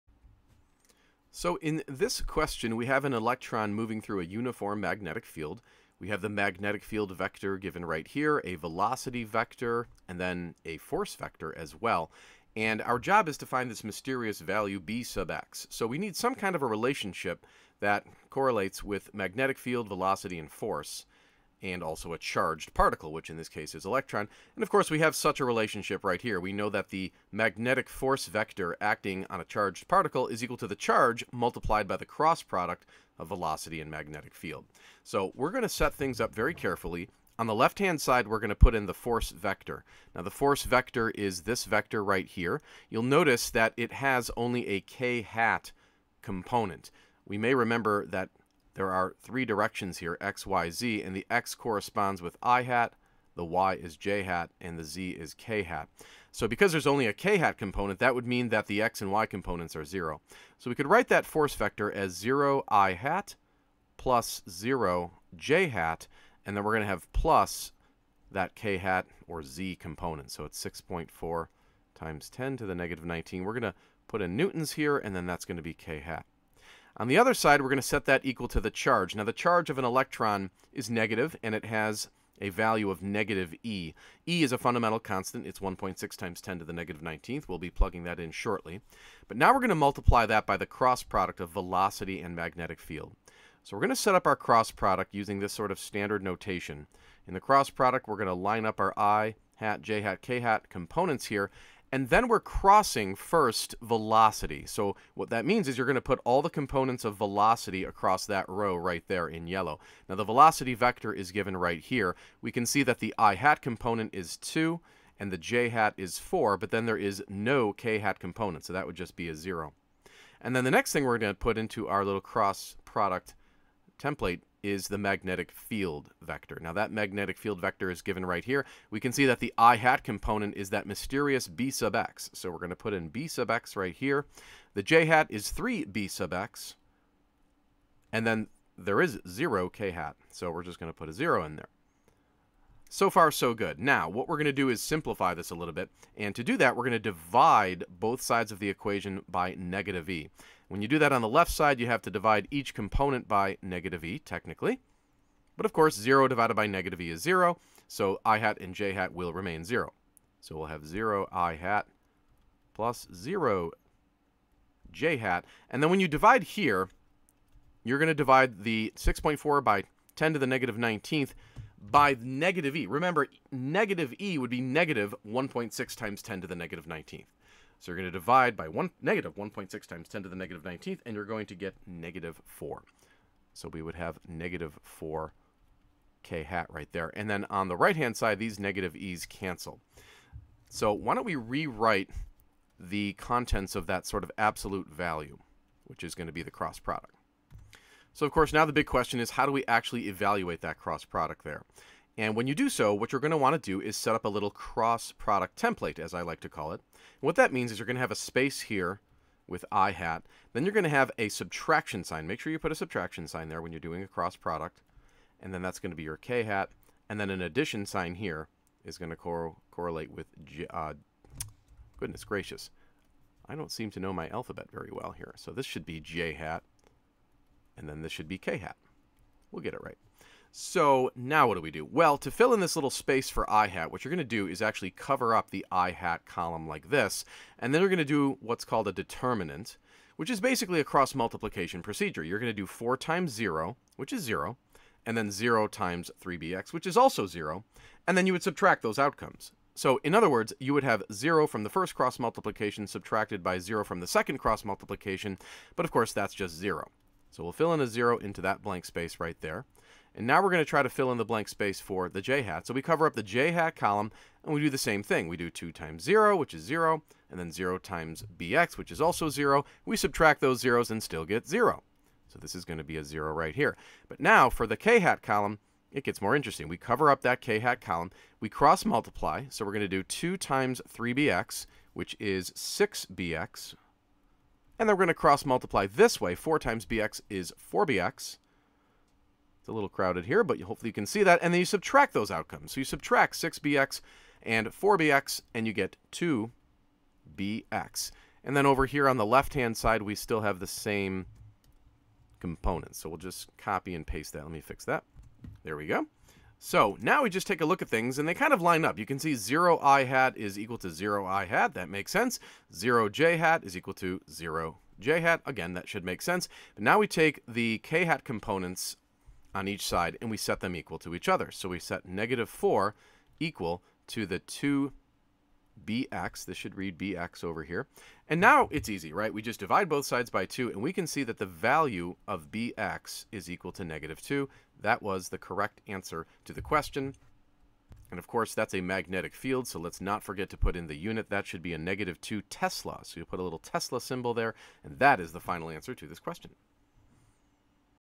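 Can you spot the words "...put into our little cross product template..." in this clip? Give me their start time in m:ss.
2:01.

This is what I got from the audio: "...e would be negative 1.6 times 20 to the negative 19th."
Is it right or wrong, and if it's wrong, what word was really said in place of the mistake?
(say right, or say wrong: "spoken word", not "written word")
wrong: "10", not "20".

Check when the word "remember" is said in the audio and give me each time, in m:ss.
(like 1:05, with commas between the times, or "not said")
0:47, 2:52.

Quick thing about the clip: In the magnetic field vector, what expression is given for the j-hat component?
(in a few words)
3 b sub x.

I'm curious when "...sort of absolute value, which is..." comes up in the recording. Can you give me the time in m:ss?
3:14.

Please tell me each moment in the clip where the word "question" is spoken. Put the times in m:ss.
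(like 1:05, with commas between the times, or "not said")
0:02, 3:18, 5:36, 5:46.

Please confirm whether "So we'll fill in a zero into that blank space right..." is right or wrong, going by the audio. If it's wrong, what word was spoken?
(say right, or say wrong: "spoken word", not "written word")
right.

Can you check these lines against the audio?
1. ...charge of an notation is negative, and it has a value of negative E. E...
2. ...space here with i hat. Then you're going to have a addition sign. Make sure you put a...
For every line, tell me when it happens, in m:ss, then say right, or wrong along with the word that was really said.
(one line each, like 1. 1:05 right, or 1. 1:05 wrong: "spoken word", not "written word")
1. 1:19 wrong: "electron", not "notation"
2. 3:28 wrong: "subtraction", not "addition".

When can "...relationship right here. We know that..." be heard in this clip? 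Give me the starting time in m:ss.
0:25.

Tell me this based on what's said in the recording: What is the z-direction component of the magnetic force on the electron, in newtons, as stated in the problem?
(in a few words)
6.4 x 10^-19.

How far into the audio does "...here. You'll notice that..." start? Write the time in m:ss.
0:42.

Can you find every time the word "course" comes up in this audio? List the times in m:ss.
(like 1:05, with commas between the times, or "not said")
0:24, 2:35, 3:18, 4:15, 5:38.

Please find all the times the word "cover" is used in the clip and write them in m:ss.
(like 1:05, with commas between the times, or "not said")
3:54, 4:22, 4:36.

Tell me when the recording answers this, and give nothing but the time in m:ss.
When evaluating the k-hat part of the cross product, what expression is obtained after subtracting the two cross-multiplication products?
4:56.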